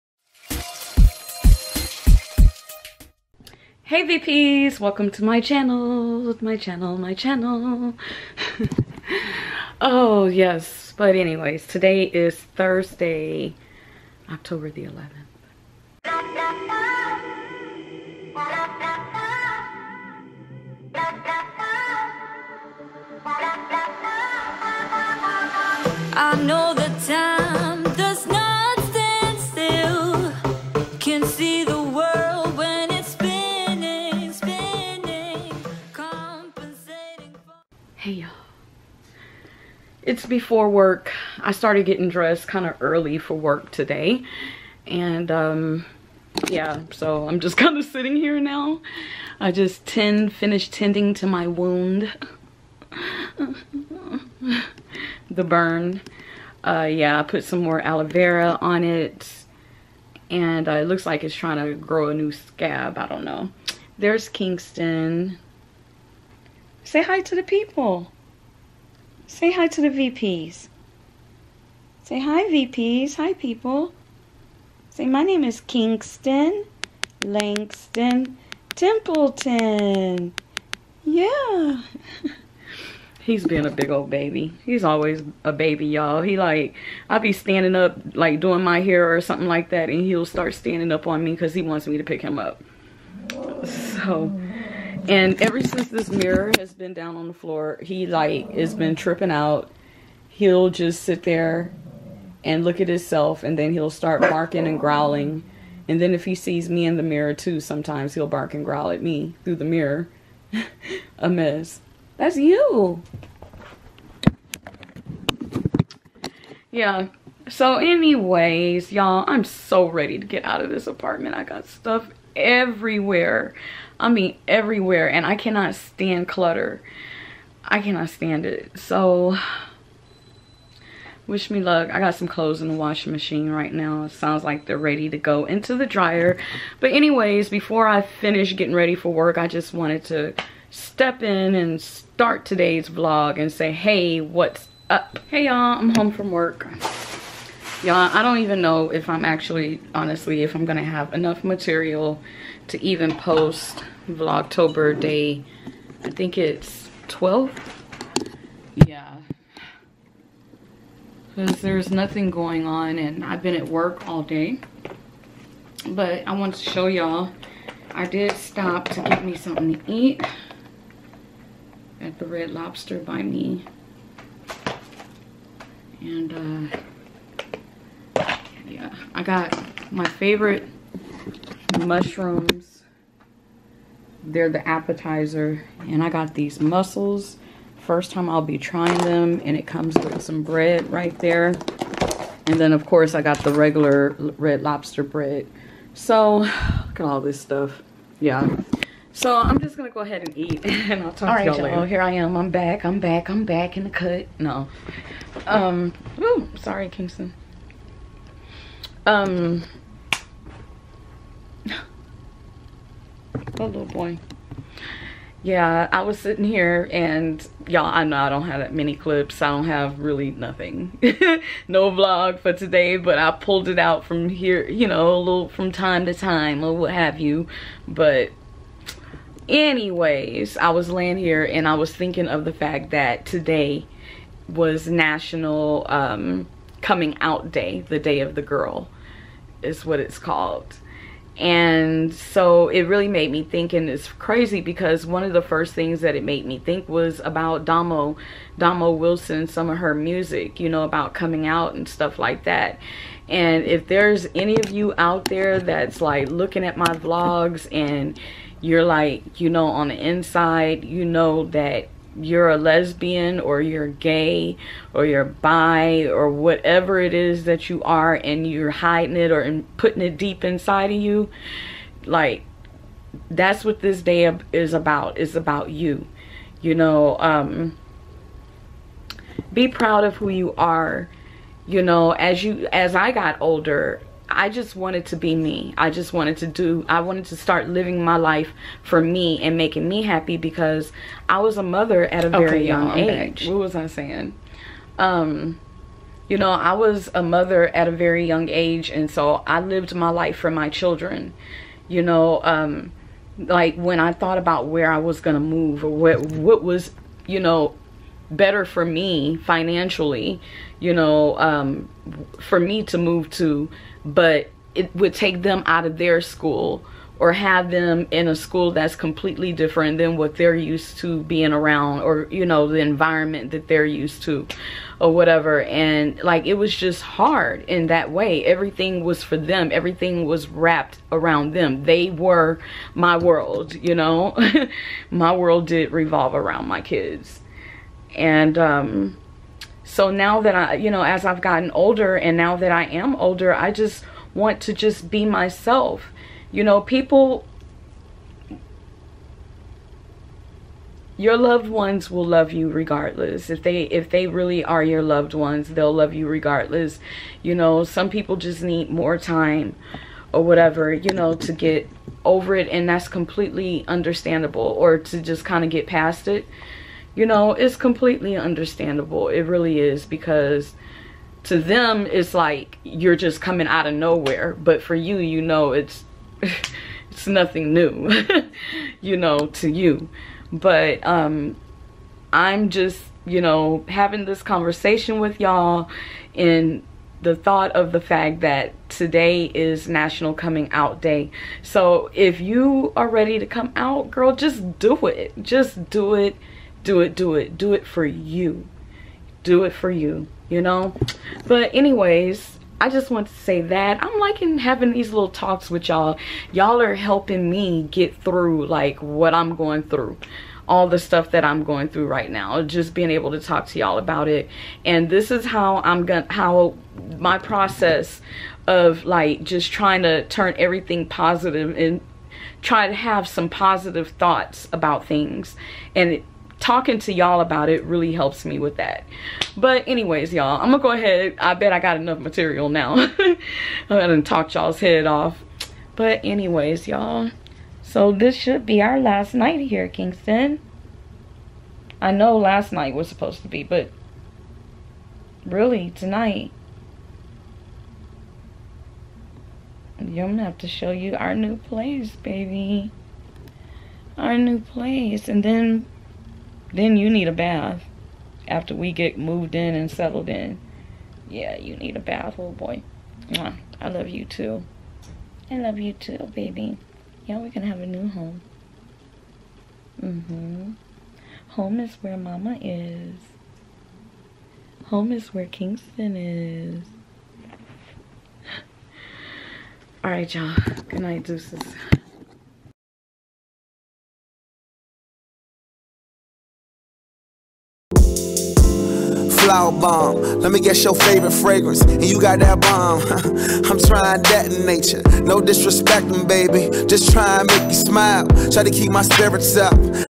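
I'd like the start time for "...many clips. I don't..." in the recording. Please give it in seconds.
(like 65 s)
218 s.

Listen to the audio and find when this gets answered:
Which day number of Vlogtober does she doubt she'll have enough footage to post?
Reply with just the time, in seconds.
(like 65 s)
157 s.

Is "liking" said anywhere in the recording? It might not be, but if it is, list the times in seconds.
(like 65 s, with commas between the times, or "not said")
404 s.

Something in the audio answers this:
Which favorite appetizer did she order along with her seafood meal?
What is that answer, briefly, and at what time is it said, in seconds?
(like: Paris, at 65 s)
Mushrooms, at 181 s.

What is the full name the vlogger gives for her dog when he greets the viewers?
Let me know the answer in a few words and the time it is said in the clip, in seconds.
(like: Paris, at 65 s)
Kingston Langston Templeton, at 75 s.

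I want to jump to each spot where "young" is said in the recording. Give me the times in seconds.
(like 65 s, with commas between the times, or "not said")
292 s, 298 s.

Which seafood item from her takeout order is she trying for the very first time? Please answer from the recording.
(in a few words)
Mussels.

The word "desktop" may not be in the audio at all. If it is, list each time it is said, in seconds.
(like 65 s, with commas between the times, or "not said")
not said.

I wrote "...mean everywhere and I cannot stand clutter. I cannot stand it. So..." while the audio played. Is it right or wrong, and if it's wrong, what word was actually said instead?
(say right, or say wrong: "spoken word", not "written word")
right.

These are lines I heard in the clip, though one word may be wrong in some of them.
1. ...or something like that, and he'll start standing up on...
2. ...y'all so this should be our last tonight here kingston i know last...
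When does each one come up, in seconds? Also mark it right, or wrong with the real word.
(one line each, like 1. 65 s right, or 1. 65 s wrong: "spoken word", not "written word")
1. 89 s right
2. 436 s wrong: "night", not "tonight".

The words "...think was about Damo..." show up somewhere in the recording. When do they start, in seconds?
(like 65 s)
246 s.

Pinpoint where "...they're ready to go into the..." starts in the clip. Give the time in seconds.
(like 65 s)
134 s.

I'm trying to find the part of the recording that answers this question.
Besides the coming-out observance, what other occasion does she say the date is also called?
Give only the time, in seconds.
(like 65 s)
237 s.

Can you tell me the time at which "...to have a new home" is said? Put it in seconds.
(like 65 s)
467 s.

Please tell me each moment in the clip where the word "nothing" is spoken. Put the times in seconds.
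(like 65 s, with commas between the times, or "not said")
161 s, 220 s, 377 s.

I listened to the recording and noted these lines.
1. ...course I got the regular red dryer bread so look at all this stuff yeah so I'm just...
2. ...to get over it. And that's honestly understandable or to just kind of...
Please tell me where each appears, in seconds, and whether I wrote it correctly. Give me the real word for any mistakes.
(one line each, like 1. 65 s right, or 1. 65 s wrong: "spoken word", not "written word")
1. 192 s wrong: "lobster", not "dryer"
2. 361 s wrong: "completely", not "honestly".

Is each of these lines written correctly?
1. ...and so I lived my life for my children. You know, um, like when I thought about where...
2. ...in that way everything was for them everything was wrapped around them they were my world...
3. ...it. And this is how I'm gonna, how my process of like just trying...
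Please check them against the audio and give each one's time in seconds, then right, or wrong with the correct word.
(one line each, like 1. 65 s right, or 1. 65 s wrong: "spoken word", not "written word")
1. 298 s right
2. 327 s right
3. 414 s right.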